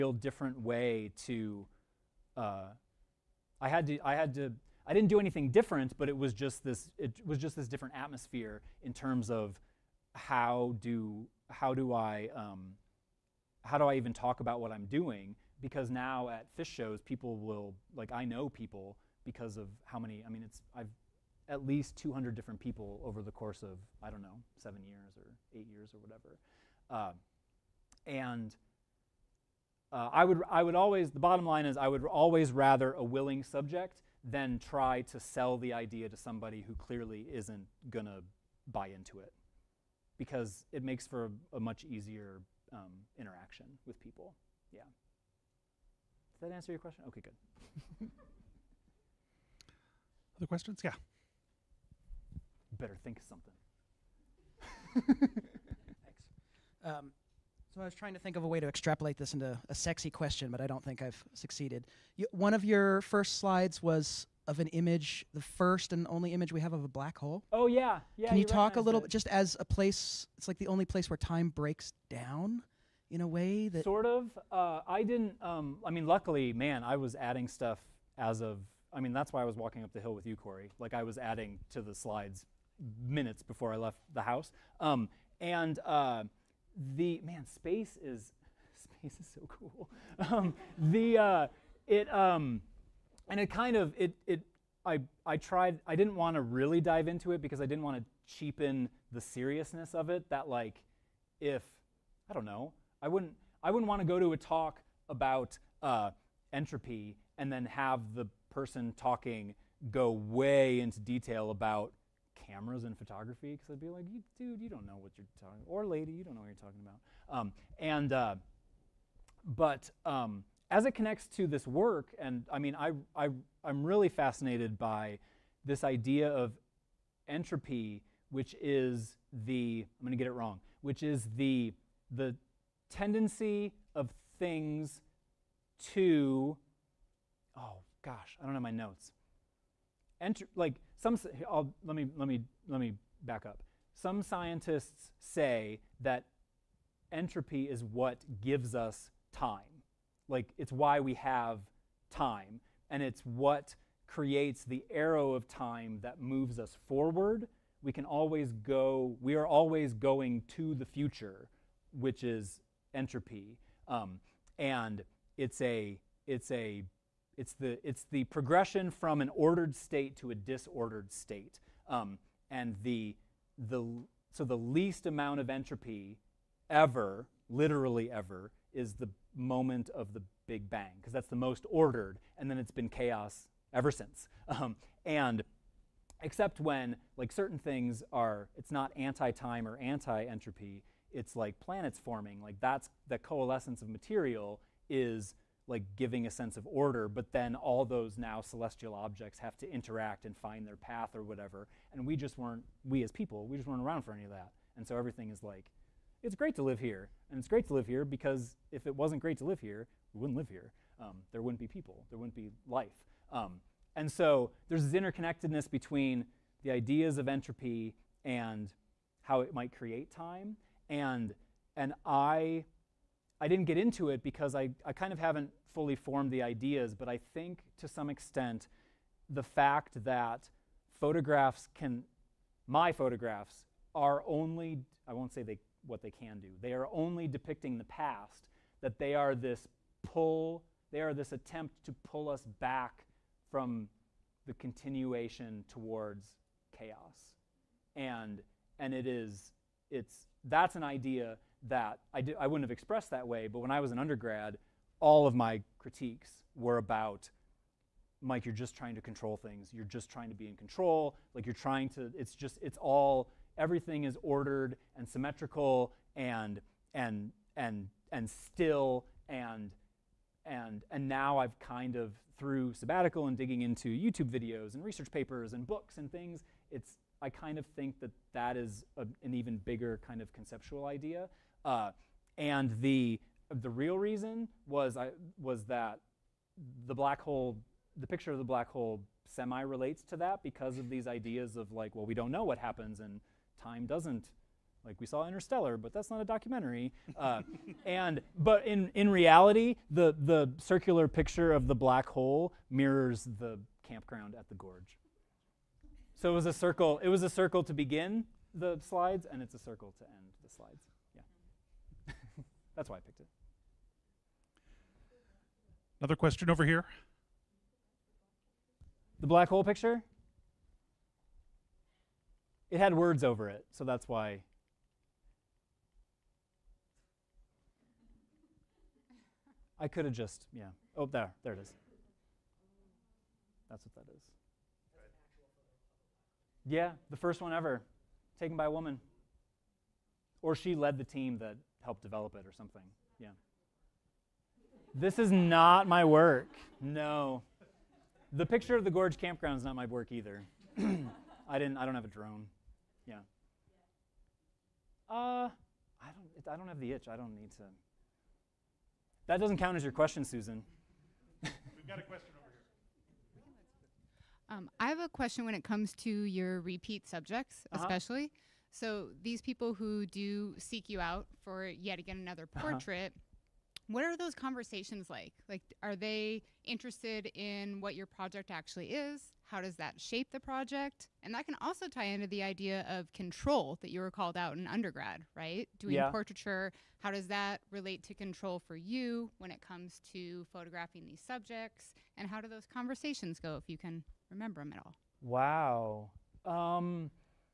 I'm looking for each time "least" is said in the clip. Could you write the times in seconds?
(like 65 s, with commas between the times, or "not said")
21 s, 174 s.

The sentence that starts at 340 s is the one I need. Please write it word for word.
Or she led the team that help develop it or something.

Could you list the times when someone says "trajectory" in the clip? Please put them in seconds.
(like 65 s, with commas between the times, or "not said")
not said.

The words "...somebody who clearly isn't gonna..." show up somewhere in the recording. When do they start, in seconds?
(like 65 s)
36 s.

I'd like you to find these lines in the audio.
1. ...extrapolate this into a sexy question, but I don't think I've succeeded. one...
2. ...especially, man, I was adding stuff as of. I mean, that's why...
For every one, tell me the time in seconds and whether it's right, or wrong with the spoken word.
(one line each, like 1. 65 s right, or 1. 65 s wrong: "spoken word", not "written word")
1. 58 s right
2. 76 s wrong: "luckily", not "especially".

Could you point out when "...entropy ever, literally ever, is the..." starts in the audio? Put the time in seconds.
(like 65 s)
175 s.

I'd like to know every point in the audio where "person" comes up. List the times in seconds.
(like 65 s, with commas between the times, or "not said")
108 s.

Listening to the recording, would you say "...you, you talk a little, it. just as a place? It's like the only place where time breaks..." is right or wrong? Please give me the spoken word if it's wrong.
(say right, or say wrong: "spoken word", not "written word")
right.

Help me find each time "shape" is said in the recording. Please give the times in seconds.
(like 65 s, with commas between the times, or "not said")
379 s.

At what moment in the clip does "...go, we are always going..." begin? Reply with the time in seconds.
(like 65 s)
158 s.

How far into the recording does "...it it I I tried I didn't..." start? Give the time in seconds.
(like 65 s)
93 s.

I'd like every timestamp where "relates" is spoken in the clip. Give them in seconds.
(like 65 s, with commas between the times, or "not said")
289 s, 387 s.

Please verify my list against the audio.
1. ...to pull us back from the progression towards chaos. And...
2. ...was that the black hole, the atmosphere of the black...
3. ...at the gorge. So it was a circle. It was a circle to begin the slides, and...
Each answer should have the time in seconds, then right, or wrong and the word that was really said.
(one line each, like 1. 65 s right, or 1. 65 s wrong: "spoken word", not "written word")
1. 241 s wrong: "continuation", not "progression"
2. 285 s wrong: "picture", not "atmosphere"
3. 304 s right.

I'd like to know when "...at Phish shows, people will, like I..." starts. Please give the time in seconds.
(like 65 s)
16 s.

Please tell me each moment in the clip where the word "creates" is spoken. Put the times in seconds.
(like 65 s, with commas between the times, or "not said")
154 s, 219 s.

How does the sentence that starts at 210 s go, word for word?
Um, there wouldn't be people, there wouldn't be life.